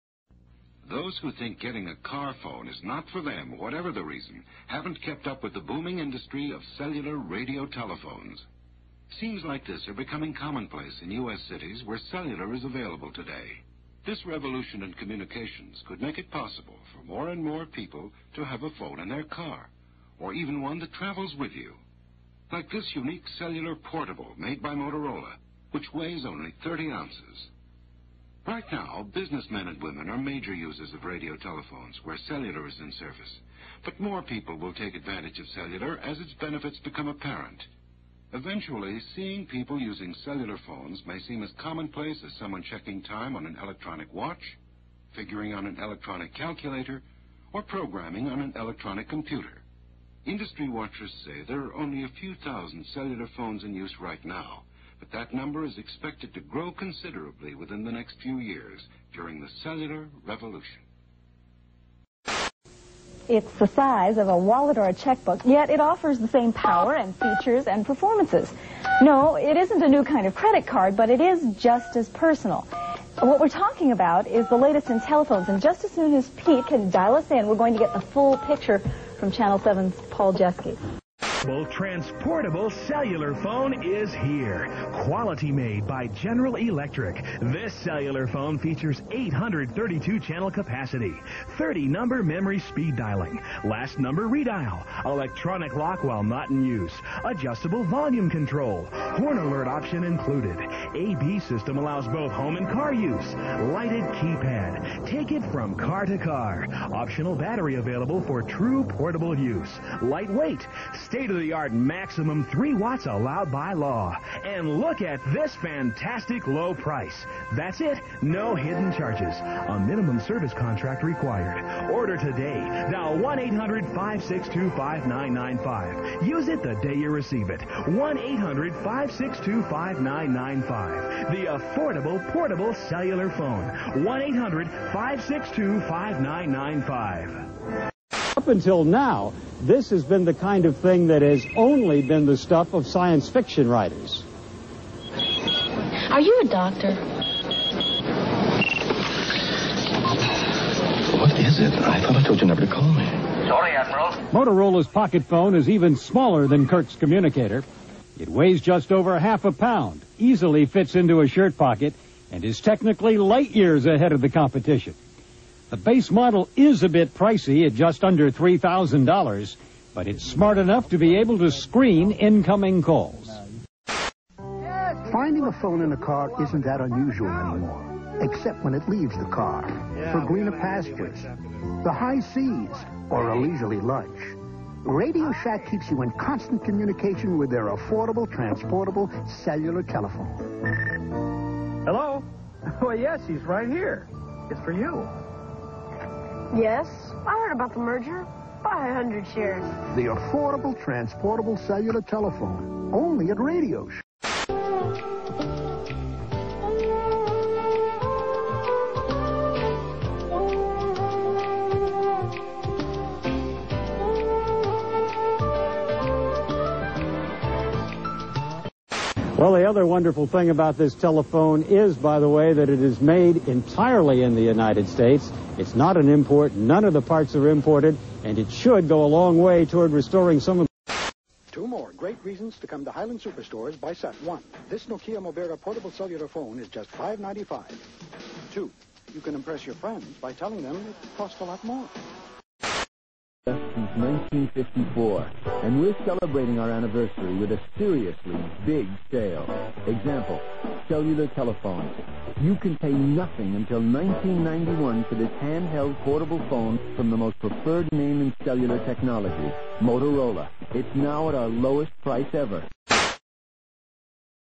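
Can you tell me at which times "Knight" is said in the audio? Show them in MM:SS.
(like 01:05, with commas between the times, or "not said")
not said.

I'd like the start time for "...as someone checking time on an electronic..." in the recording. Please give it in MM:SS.
00:42.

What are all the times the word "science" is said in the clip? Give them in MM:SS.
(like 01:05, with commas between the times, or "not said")
02:22.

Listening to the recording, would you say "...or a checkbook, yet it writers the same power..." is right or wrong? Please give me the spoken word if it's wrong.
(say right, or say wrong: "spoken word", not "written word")
wrong: "offers", not "writers".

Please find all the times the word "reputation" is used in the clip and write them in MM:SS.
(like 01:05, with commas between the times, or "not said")
not said.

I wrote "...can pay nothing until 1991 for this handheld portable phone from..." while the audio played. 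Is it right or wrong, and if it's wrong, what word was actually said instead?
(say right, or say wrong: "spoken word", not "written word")
right.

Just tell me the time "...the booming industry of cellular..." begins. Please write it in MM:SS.
00:05.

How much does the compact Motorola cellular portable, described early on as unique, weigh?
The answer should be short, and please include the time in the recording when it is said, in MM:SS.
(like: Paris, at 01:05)
30 ounces, at 00:26.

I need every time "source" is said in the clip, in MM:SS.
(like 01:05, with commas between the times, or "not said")
not said.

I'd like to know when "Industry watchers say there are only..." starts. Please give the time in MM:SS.
00:50.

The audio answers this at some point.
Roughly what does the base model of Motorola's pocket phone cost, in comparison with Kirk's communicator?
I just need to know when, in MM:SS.
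02:47.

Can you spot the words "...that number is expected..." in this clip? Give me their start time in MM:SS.
00:55.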